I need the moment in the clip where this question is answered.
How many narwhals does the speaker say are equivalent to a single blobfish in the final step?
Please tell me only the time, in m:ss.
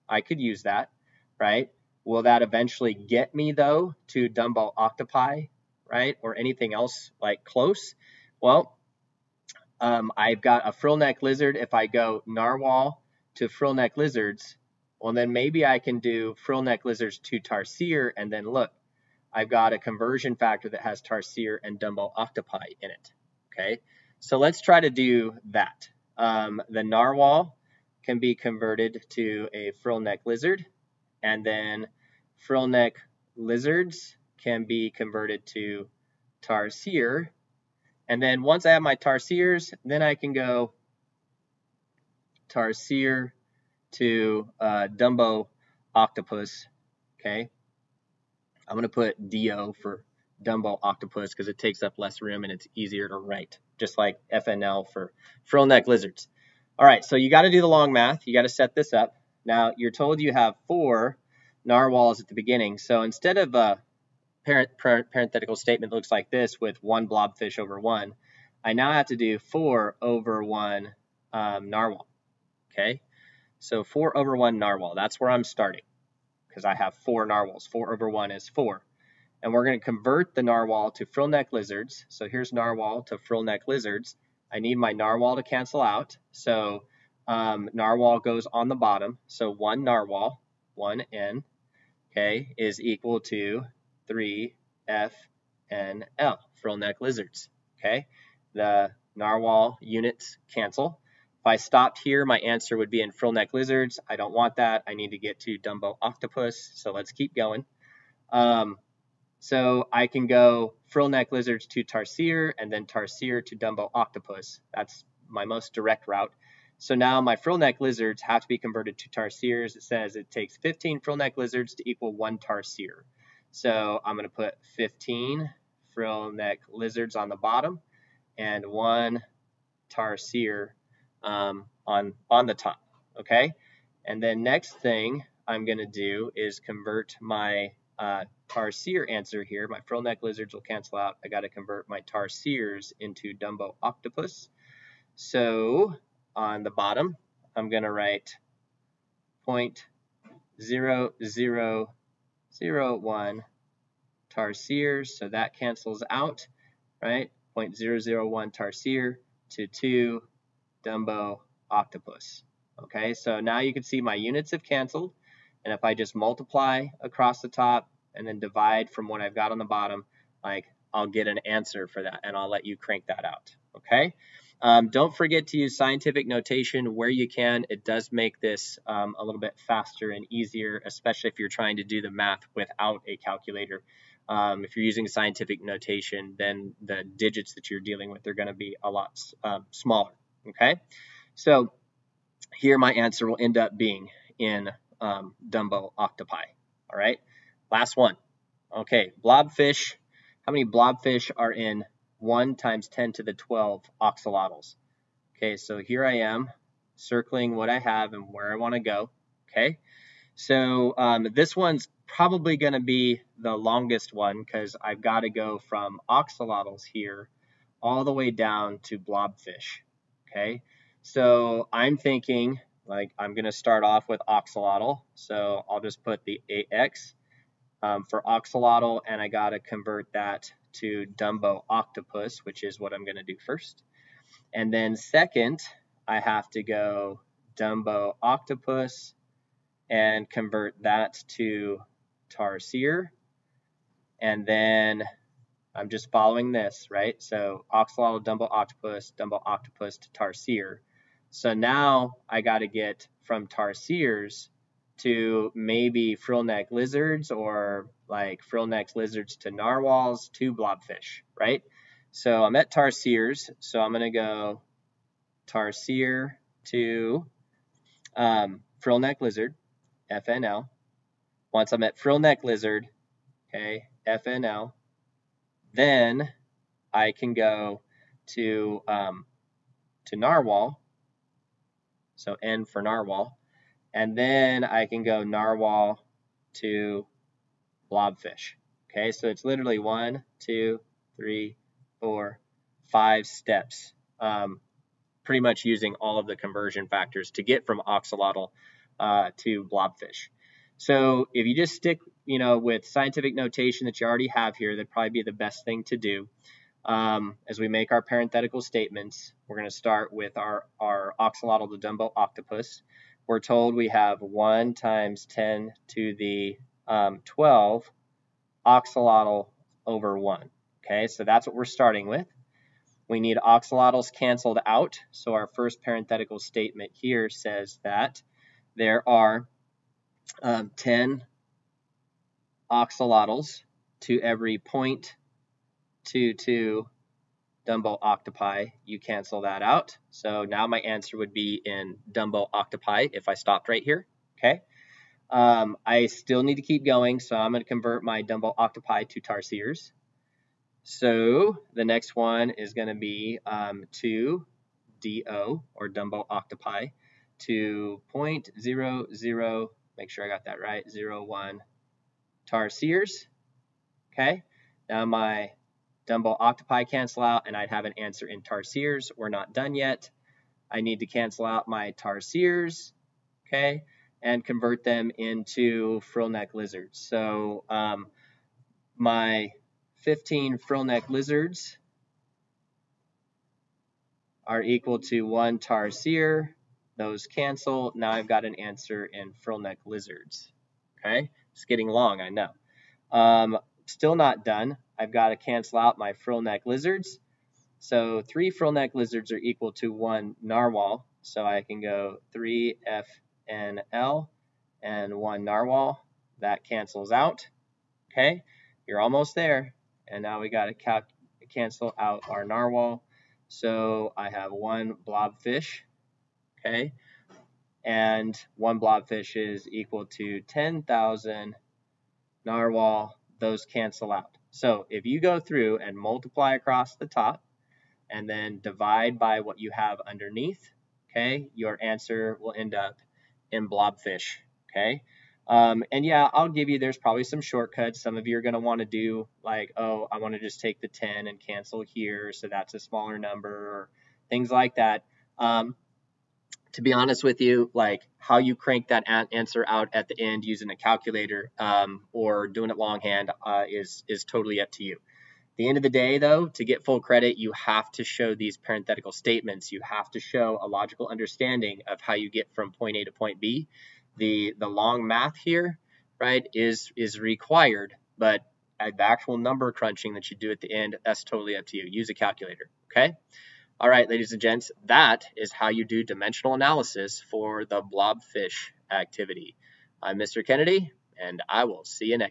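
7:00.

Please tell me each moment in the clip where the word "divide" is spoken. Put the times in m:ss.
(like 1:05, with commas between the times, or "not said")
2:48, 7:08.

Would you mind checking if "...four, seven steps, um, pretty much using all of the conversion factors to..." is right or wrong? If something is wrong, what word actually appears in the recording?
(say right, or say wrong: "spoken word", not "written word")
wrong: "five", not "seven".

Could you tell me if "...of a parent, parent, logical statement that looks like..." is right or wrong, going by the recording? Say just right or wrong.
wrong.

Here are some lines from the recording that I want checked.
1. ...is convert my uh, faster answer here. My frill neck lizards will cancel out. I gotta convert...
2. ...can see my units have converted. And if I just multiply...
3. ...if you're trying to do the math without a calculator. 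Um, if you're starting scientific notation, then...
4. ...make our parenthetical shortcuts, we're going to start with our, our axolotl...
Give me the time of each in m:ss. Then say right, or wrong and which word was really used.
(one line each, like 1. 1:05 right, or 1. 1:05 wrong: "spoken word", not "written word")
1. 2:16 wrong: "tarsier", not "faster"
2. 2:43 wrong: "canceled", not "converted"
3. 3:01 wrong: "using", not "starting"
4. 5:07 wrong: "statements", not "shortcuts".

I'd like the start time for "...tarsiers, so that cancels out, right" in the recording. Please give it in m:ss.
2:34.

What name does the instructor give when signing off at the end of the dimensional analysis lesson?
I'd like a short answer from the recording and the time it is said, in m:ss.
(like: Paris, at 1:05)
Mr. Kennedy, at 8:00.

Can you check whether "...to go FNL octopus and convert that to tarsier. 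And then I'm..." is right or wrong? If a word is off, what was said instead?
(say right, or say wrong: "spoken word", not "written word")
wrong: "Dumbo", not "FNL".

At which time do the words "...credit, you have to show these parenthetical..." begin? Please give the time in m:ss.
7:36.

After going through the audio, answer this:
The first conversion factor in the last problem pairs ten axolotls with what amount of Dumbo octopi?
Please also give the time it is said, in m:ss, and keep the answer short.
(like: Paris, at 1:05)
0.22, at 5:34.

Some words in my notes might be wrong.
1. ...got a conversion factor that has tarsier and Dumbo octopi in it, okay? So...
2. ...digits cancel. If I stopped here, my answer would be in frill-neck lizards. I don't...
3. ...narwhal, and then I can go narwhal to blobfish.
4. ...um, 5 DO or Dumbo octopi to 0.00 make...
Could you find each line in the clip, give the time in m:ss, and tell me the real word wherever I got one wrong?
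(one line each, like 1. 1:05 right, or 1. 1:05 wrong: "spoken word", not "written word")
1. 0:19 right
2. 1:39 wrong: "units", not "digits"
3. 4:42 right
4. 5:53 wrong: "2", not "5".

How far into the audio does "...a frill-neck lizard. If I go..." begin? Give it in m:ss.
0:10.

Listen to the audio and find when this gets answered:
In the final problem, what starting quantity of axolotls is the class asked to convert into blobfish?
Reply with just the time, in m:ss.
3:22.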